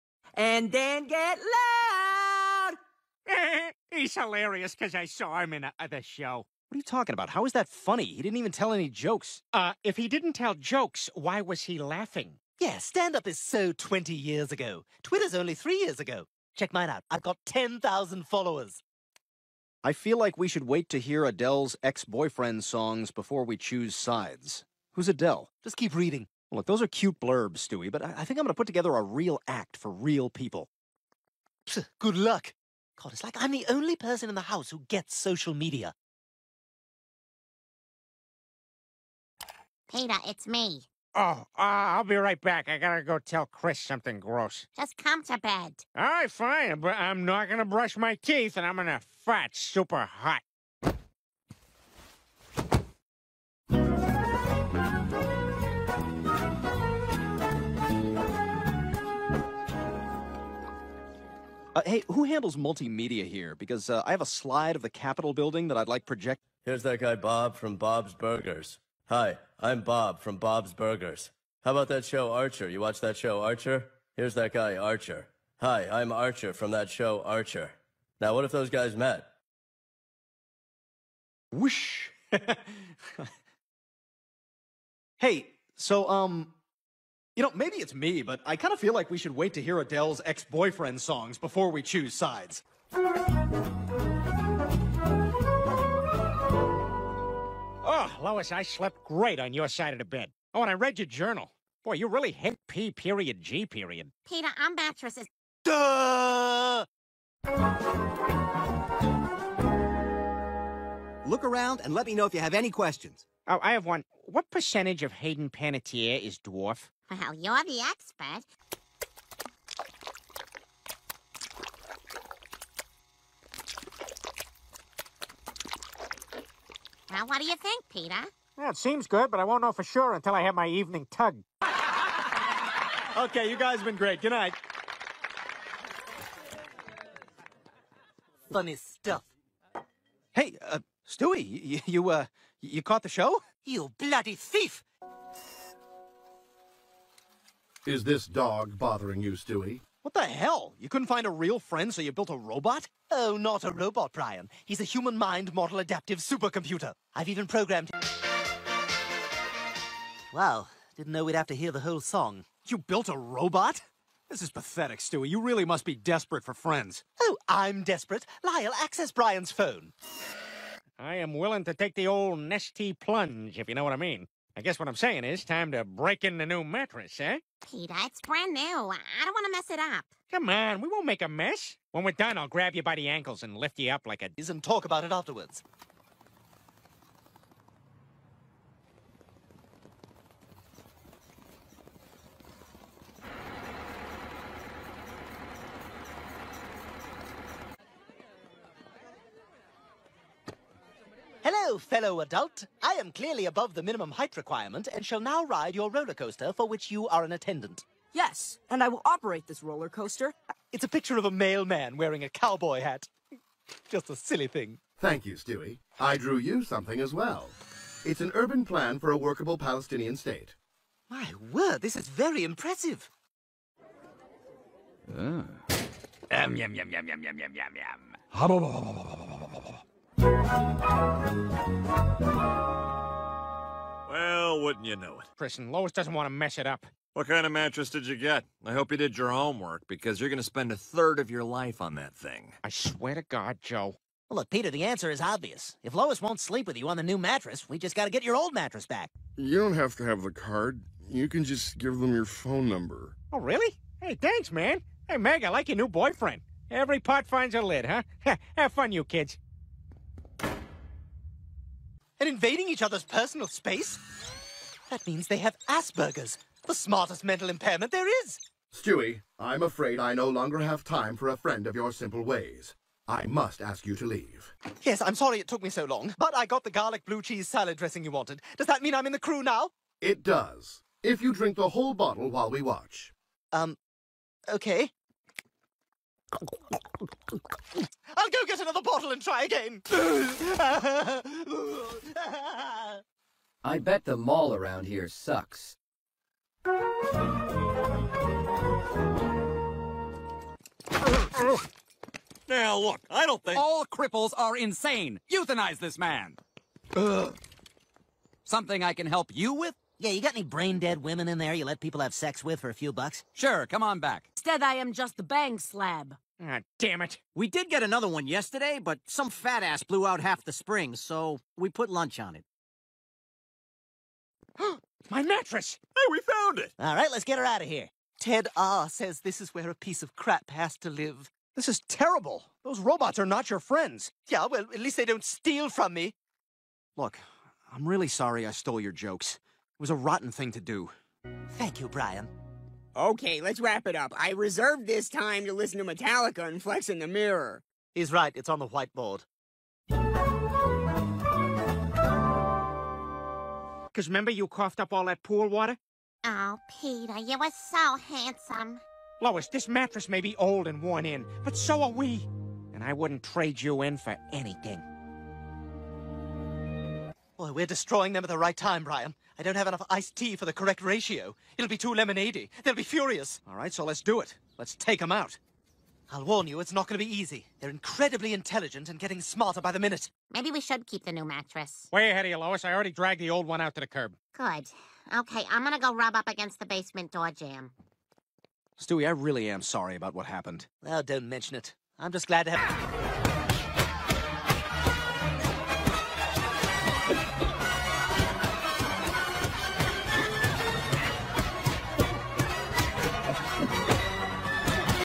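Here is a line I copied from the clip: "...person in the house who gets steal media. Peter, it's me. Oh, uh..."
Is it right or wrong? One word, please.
wrong.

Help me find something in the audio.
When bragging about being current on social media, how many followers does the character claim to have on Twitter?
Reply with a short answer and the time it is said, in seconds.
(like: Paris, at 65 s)
10,000, at 17 s.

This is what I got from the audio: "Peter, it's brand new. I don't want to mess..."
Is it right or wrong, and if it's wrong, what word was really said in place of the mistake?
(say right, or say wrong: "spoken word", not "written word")
right.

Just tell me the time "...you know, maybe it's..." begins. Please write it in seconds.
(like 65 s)
87 s.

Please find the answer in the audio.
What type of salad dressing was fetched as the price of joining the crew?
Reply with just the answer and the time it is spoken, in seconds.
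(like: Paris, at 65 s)
garlic blue cheese, at 276 s.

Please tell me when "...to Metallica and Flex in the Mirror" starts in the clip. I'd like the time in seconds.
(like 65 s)
345 s.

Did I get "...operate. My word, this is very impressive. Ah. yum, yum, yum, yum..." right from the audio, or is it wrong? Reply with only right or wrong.
wrong.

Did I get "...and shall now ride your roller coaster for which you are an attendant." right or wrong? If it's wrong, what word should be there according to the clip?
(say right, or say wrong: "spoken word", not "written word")
right.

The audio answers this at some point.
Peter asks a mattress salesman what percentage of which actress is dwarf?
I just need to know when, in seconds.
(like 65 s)
115 s.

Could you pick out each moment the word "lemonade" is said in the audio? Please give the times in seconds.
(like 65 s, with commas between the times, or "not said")
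371 s.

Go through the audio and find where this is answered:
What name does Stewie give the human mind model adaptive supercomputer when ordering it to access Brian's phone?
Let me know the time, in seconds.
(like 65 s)
168 s.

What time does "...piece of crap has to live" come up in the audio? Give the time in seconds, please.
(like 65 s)
329 s.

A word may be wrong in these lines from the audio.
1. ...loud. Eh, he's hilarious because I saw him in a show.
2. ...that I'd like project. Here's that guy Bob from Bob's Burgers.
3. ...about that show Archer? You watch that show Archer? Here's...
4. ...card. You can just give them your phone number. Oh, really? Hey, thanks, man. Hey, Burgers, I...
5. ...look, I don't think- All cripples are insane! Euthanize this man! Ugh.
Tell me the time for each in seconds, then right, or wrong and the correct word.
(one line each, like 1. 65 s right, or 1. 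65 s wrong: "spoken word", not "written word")
1. 1 s right
2. 65 s right
3. 71 s right
4. 250 s wrong: "Meg", not "Burgers"
5. 302 s right.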